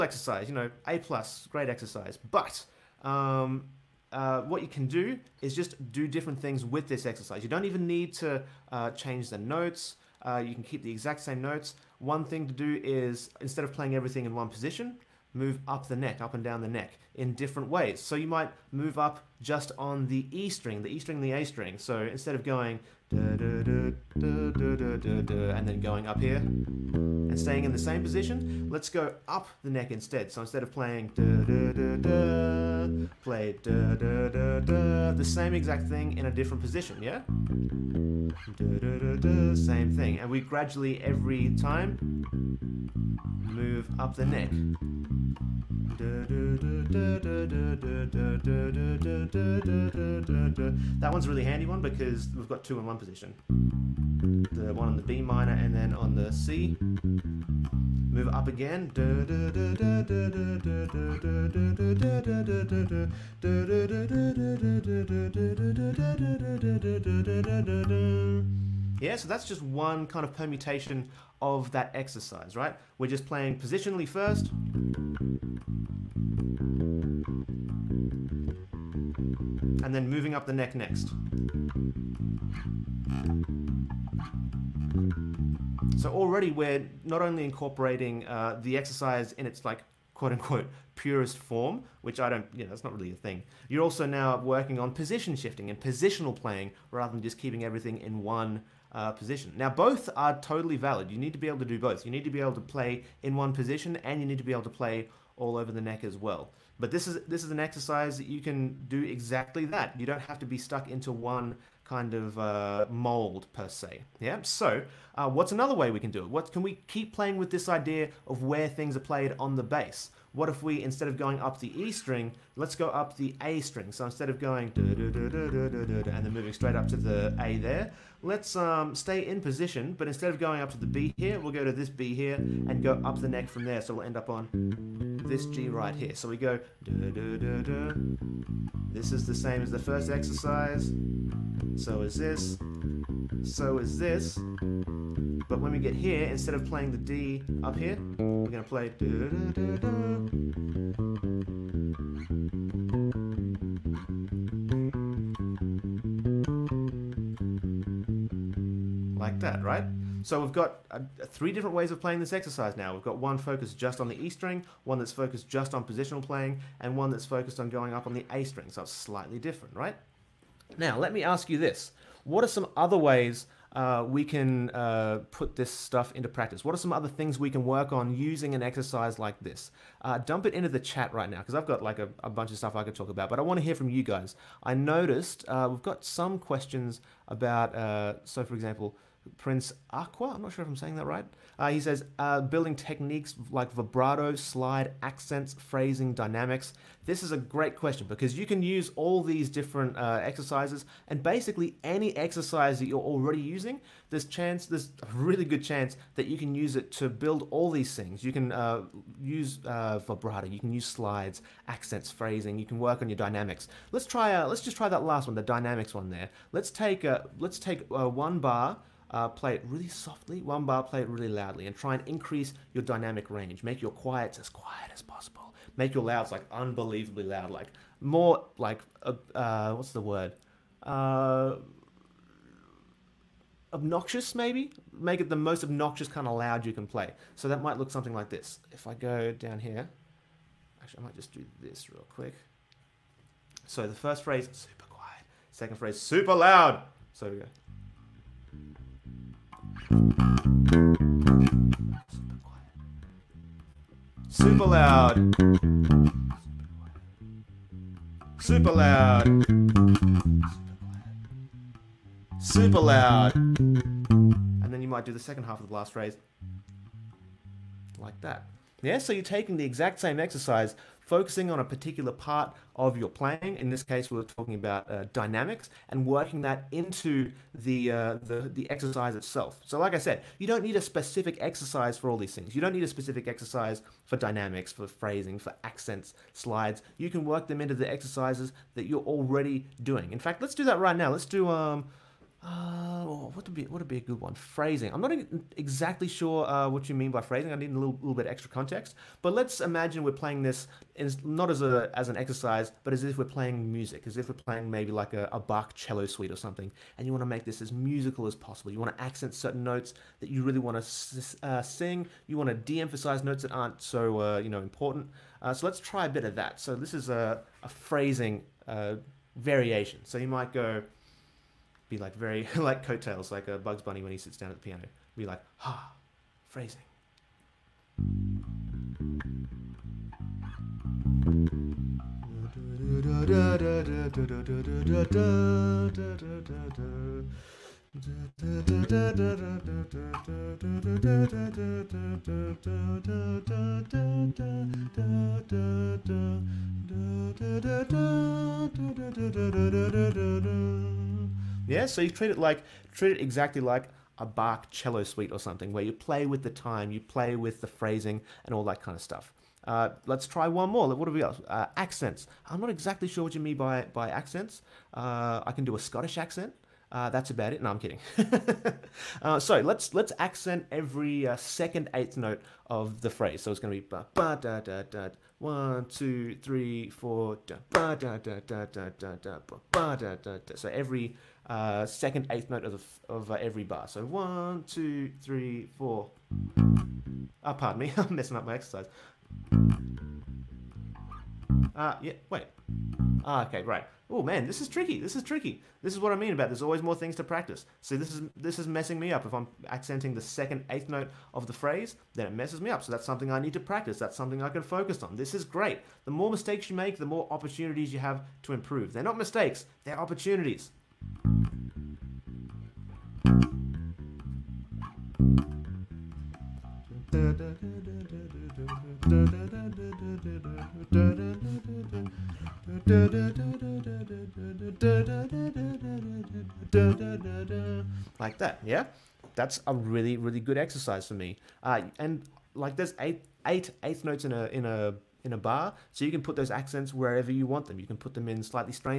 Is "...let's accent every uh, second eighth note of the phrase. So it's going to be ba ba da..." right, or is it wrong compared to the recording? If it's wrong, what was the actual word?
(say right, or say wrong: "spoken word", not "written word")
right.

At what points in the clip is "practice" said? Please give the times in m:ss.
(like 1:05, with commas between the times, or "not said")
2:56, 6:37, 6:43.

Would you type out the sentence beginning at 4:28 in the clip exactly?
Yeah, so you're taking the exact same exercise focusing on a particular part of your playing.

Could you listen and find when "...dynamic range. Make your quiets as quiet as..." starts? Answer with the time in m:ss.
3:42.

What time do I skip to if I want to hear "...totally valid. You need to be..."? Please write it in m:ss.
1:40.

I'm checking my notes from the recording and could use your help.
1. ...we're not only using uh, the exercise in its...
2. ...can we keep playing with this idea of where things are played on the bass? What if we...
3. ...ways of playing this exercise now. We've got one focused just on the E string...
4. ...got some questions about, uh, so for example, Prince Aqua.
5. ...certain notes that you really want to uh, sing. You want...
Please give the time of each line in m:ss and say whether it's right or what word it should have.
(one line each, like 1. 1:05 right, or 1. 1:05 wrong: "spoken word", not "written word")
1. 1:26 wrong: "incorporating", not "using"
2. 1:56 right
3. 2:41 right
4. 3:05 right
5. 5:09 right.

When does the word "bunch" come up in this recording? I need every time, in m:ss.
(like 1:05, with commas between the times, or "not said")
3:02.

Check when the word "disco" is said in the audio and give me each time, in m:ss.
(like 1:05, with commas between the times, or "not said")
not said.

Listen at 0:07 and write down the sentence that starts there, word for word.
You don't even need to uh, change the notes.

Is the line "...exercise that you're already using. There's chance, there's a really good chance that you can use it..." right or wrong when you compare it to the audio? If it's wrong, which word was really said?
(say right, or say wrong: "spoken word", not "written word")
right.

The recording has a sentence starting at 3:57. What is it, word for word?
So that might look something like this.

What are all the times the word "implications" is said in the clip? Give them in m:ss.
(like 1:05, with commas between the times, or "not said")
not said.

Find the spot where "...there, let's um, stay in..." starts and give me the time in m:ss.
2:07.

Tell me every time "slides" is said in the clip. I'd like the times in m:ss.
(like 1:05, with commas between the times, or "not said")
3:14, 3:30, 4:46.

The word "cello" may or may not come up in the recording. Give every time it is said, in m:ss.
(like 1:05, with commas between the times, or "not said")
5:05, 5:54.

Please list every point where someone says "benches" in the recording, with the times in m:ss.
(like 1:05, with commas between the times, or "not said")
not said.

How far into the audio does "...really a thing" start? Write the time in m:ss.
1:32.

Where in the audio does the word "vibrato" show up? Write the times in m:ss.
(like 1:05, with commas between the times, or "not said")
3:13, 3:30.